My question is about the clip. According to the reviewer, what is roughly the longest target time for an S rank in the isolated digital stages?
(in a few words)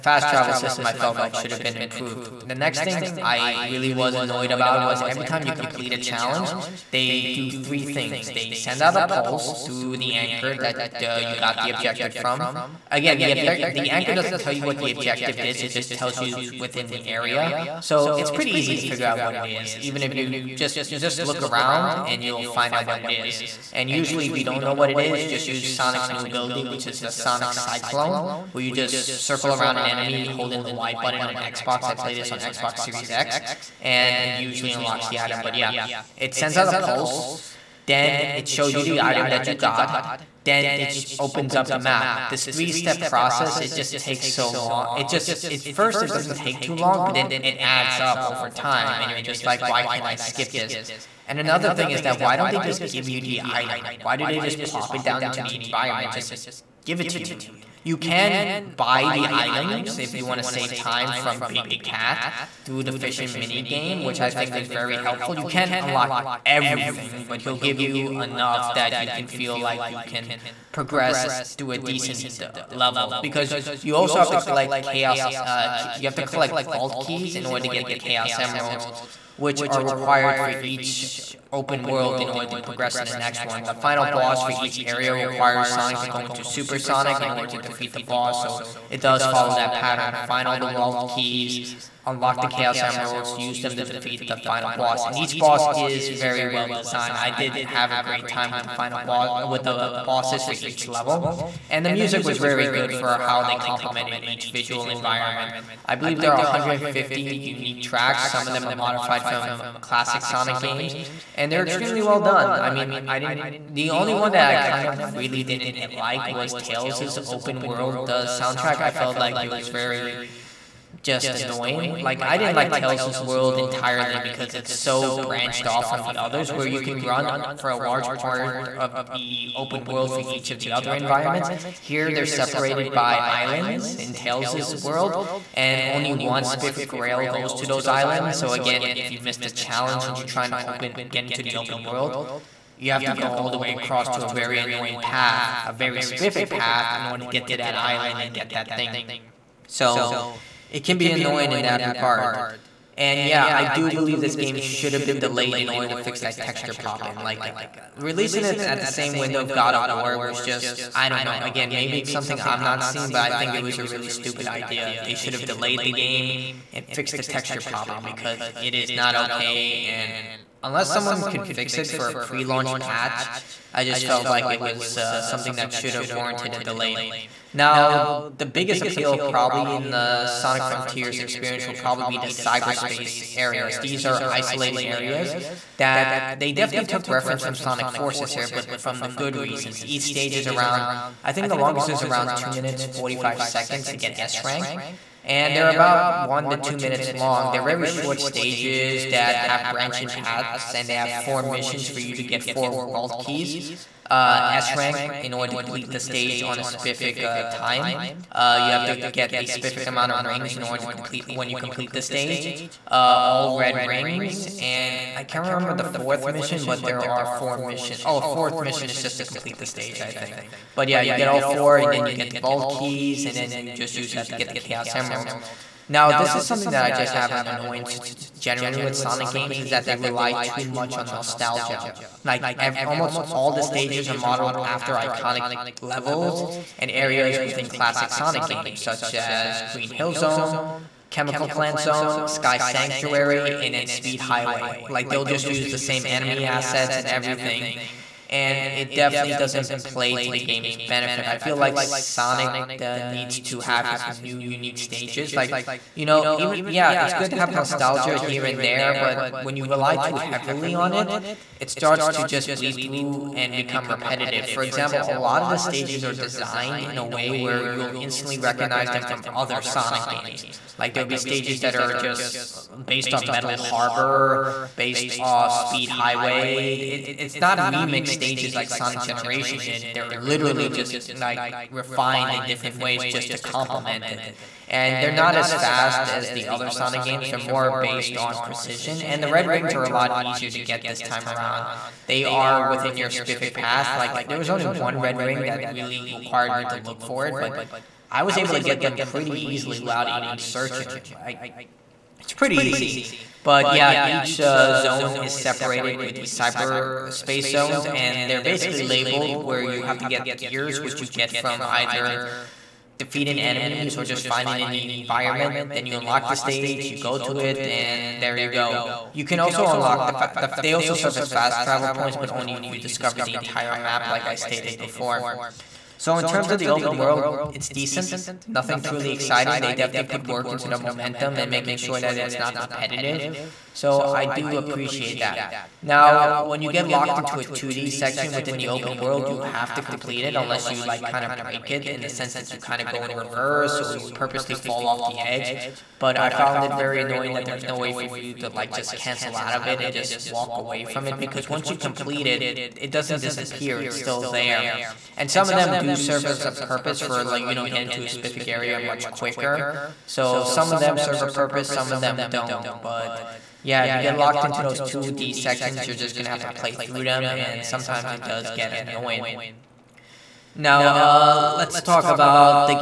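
2 minutes 45 seconds.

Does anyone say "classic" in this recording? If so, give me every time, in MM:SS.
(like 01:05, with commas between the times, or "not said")
01:49, 03:57.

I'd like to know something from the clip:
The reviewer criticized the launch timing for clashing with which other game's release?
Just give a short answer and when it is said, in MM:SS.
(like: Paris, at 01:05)
God of War, at 02:39.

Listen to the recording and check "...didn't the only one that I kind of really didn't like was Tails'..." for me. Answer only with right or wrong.
right.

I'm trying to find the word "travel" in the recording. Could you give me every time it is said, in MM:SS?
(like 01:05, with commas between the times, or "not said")
00:00, 05:21.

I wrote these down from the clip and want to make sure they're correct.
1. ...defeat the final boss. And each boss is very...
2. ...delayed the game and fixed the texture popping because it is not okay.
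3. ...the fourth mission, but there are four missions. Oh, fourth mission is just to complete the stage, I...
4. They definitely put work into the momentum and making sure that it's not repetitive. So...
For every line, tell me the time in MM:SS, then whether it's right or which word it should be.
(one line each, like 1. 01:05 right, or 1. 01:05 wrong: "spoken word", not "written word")
1. 01:33 right
2. 02:45 right
3. 03:35 right
4. 05:29 right.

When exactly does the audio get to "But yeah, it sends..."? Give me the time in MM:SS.
00:35.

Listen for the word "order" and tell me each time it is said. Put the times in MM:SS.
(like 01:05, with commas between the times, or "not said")
01:17, 01:22, 01:27, 02:27, 02:35, 03:25, 03:30.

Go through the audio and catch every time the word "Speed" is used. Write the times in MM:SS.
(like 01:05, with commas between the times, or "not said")
04:03, 04:35.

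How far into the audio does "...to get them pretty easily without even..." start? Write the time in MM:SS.
04:58.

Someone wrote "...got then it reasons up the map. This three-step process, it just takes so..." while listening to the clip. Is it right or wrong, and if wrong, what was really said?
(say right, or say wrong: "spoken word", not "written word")
wrong: "opens", not "reasons".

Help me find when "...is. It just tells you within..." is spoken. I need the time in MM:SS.
00:15.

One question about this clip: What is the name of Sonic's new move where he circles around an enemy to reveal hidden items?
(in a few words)
Sonic Cyclone.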